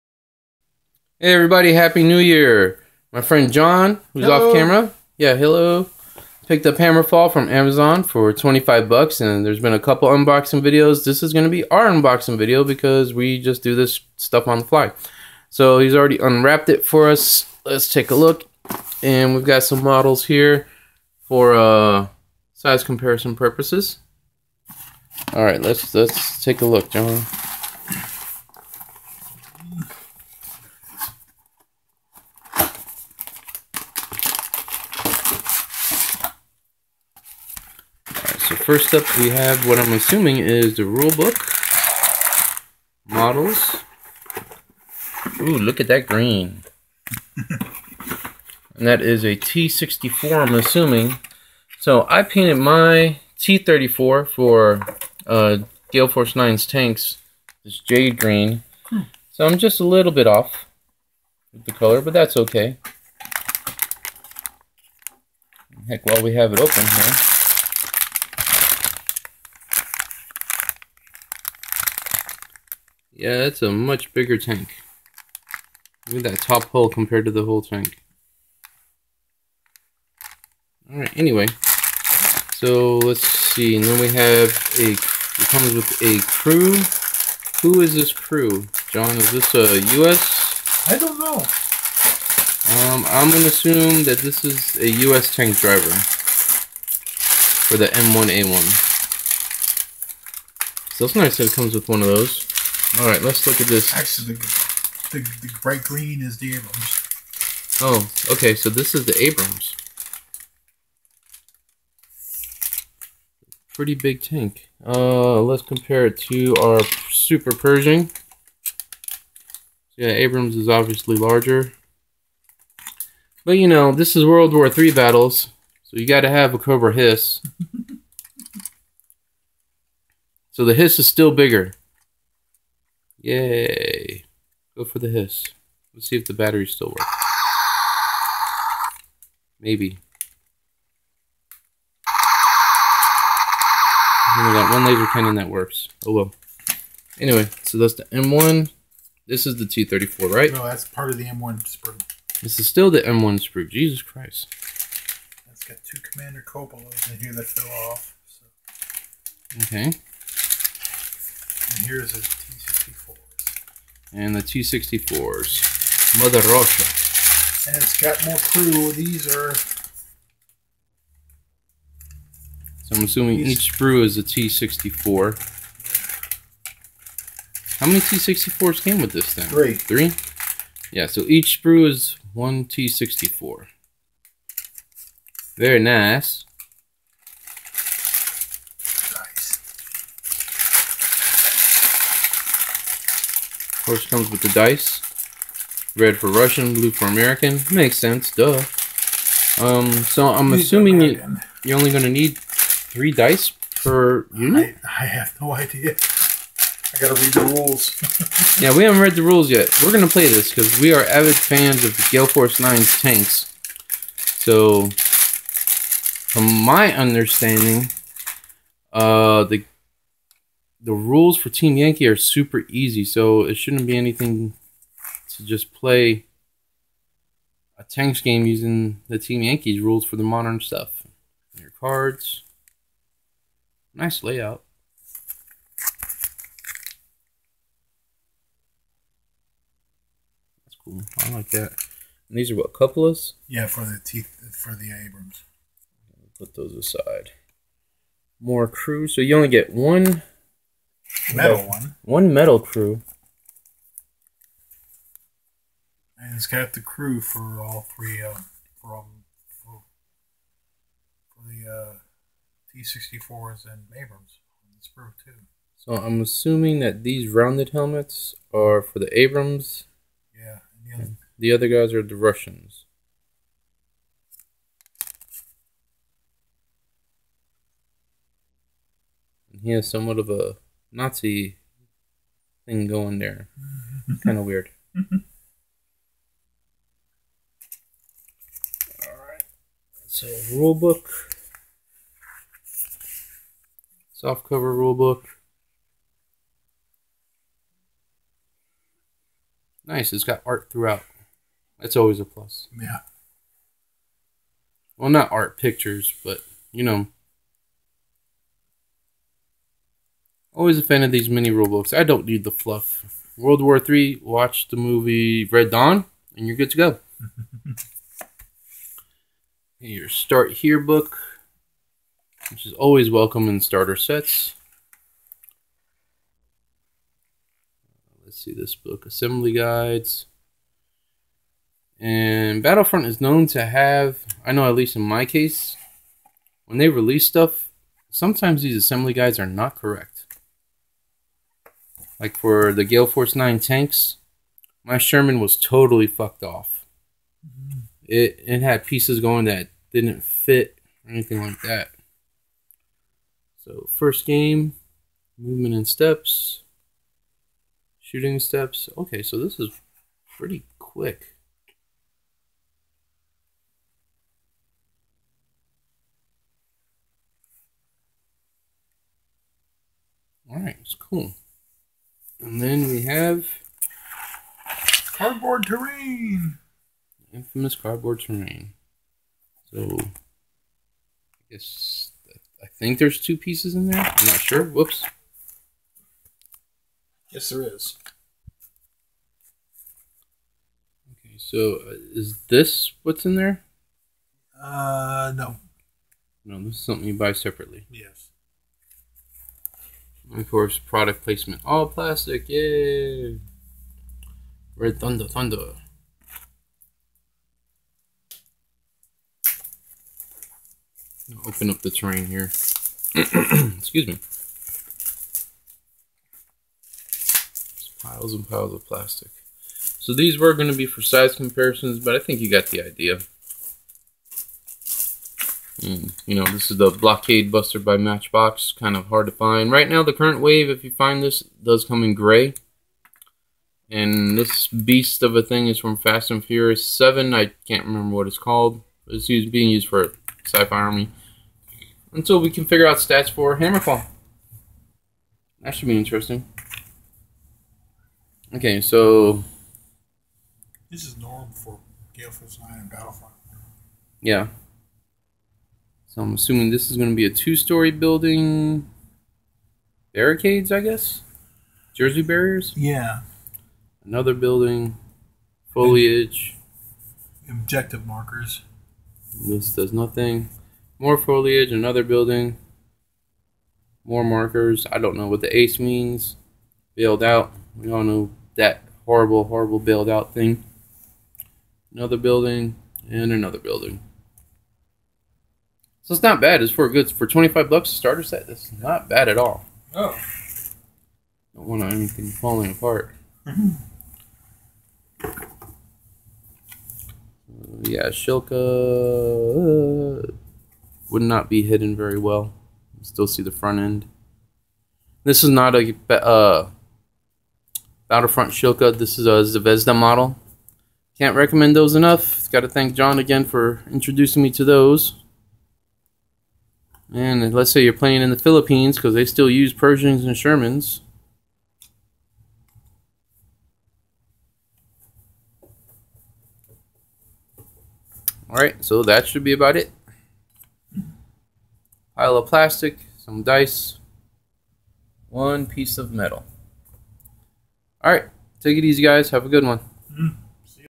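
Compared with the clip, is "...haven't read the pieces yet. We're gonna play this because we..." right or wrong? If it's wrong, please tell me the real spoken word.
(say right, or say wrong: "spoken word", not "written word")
wrong: "rules", not "pieces".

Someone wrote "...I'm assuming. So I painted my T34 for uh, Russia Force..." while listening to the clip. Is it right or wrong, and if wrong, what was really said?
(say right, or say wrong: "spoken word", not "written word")
wrong: "Gale", not "Russia".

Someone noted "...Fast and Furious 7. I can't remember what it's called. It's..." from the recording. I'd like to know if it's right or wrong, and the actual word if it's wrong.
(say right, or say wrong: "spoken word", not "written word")
right.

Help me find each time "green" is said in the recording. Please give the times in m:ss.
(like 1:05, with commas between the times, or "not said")
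0:46, 0:58, 1:45.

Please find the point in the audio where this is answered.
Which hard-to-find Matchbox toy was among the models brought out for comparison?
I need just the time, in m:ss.
7:06.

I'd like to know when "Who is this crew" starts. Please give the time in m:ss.
1:27.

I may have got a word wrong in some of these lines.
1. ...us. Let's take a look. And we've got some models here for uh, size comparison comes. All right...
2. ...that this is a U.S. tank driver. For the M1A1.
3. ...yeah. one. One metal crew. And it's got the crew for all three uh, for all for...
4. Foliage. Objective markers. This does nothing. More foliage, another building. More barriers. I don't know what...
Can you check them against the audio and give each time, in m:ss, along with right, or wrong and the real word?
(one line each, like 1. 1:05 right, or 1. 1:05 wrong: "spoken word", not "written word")
1. 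0:17 wrong: "purposes", not "comes"
2. 1:34 right
3. 4:11 right
4. 7:45 wrong: "markers", not "barriers".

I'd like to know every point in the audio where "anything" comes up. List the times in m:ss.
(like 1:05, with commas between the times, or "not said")
3:43, 5:51, 8:11.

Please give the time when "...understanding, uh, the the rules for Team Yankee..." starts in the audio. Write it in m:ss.
3:36.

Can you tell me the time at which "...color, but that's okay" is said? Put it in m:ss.
1:01.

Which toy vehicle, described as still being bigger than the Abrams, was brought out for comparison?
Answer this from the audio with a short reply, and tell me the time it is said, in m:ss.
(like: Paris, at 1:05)
Cobra Hiss, at 2:06.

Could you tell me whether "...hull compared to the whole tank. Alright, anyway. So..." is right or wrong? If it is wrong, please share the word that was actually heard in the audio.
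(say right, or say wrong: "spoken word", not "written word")
right.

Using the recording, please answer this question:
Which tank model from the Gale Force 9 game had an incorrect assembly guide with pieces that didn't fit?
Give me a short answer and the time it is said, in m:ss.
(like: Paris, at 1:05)
Sherman, at 5:44.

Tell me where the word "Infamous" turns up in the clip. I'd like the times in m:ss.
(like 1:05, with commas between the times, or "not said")
6:17.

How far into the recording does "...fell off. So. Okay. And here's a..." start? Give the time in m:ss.
2:37.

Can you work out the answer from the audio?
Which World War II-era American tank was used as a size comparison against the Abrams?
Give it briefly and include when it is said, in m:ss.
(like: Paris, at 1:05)
Super Pershing, at 1:57.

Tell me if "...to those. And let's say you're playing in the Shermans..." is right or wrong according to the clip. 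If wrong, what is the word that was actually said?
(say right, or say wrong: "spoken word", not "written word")
wrong: "Philippines", not "Shermans".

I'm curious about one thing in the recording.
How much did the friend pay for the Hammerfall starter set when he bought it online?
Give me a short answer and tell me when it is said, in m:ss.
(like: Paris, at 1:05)
$25, at 0:08.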